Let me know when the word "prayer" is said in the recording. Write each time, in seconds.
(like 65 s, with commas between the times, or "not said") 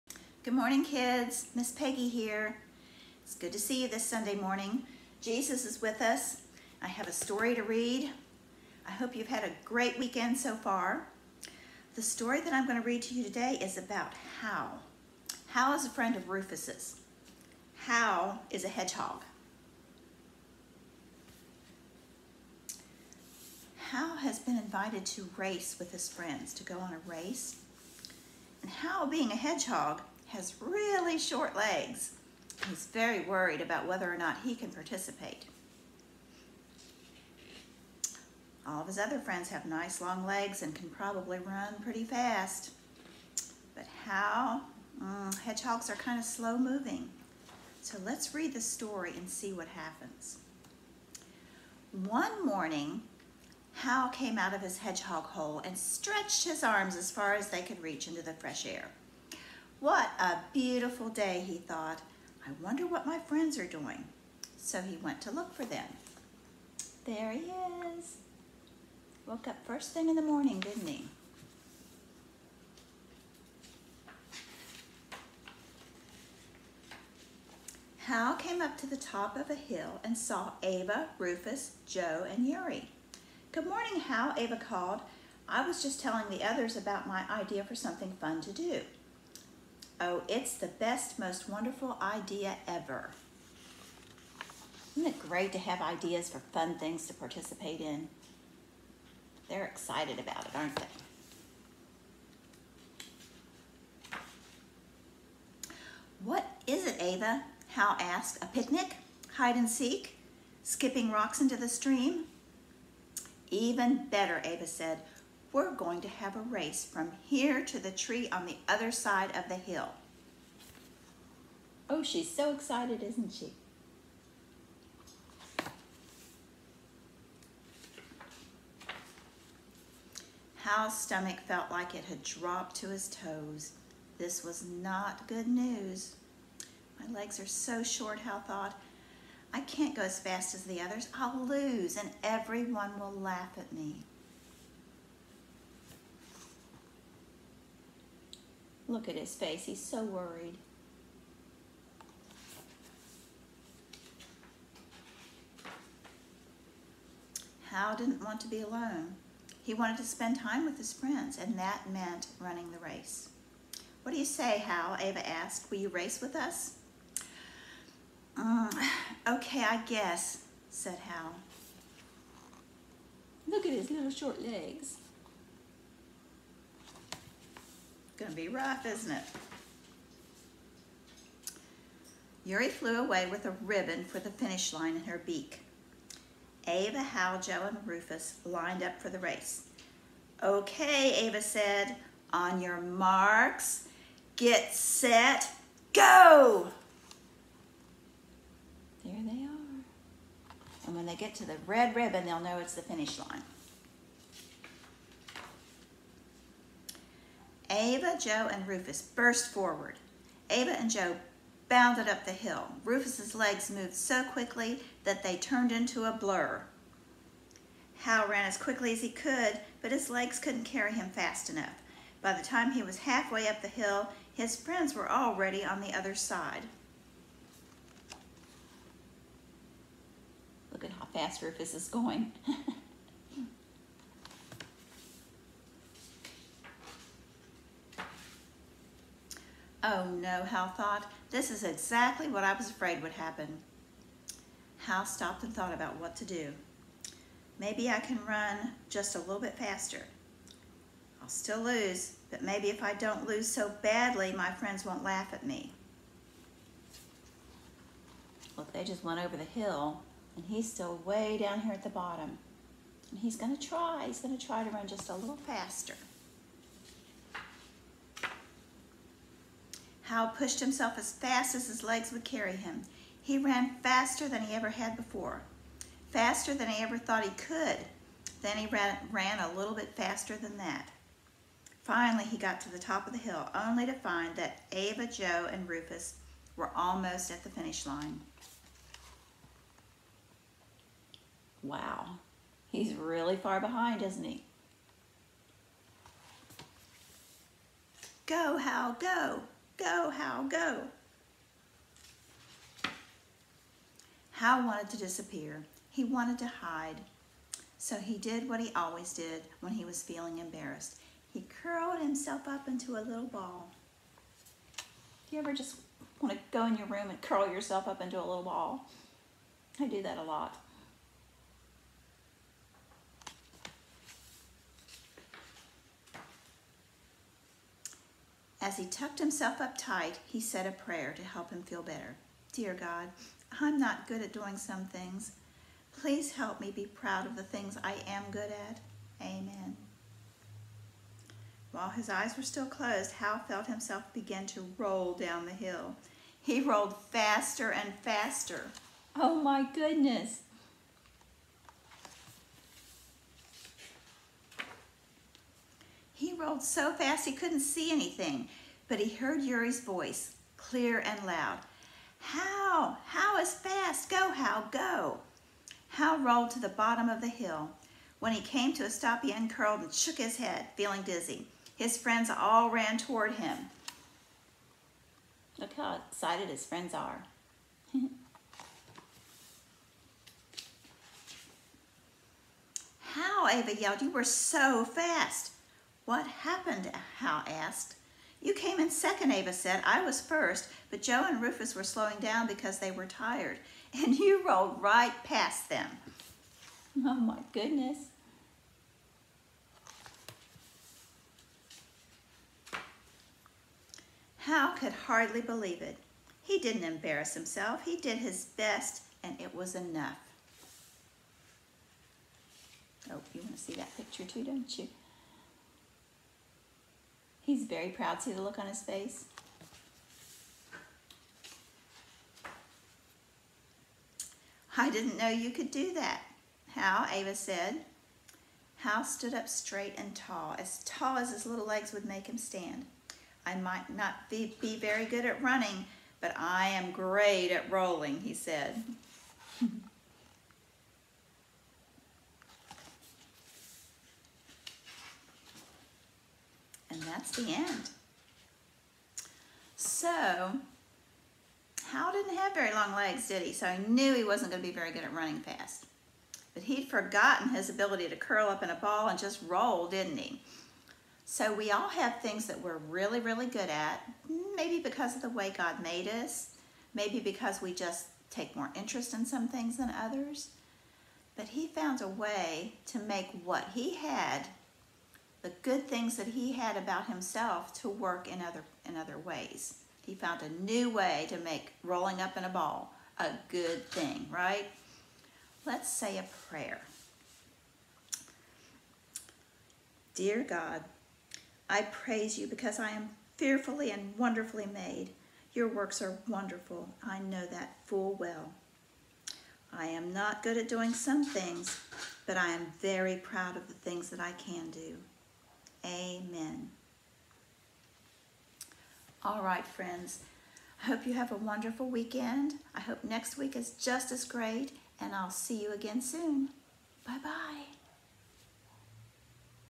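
330 s, 486 s.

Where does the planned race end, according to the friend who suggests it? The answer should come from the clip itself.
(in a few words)
The tree on the other side of the hill.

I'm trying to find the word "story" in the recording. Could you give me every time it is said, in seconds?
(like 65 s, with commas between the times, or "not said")
7 s, 12 s, 48 s.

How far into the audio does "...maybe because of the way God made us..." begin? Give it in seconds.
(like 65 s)
464 s.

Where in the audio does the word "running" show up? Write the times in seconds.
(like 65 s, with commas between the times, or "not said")
162 s, 435 s, 455 s.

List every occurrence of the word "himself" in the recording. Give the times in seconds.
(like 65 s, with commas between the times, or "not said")
270 s, 311 s, 329 s, 343 s, 407 s, 477 s.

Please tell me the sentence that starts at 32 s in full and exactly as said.
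He's very worried about whether or not he can participate.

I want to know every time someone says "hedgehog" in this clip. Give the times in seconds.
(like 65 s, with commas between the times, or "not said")
18 s, 29 s, 45 s, 54 s.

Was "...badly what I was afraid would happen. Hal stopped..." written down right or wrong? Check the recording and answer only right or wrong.
wrong.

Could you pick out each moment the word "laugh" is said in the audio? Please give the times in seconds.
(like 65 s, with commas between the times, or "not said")
143 s, 255 s.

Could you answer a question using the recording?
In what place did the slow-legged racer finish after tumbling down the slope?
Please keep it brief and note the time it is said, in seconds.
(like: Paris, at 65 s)
Second, at 388 s.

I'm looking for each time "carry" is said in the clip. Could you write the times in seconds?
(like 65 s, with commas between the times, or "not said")
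220 s, 272 s.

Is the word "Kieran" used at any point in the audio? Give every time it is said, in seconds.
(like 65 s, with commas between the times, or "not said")
not said.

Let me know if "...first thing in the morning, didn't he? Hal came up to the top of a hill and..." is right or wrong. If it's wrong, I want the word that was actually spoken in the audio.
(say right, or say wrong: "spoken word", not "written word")
right.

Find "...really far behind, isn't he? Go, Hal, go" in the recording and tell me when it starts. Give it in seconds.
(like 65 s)
292 s.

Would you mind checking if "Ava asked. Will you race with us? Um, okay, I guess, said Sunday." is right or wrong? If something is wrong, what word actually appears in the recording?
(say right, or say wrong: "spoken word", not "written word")
wrong: "Hal", not "Sunday".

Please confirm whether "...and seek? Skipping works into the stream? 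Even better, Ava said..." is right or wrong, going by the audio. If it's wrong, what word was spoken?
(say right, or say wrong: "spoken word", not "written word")
wrong: "rocks", not "works".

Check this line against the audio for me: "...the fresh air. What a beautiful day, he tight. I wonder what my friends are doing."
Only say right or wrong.
wrong.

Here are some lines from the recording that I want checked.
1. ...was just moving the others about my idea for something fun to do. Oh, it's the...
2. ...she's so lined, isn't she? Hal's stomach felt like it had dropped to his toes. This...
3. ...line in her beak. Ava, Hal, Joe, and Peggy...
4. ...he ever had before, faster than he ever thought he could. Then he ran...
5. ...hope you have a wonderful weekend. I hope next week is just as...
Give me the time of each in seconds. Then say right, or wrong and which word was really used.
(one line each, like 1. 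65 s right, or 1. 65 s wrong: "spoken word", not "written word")
1. 85 s wrong: "telling", not "moving"
2. 122 s wrong: "excited", not "lined"
3. 184 s wrong: "Rufus", not "Peggy"
4. 274 s right
5. 510 s right.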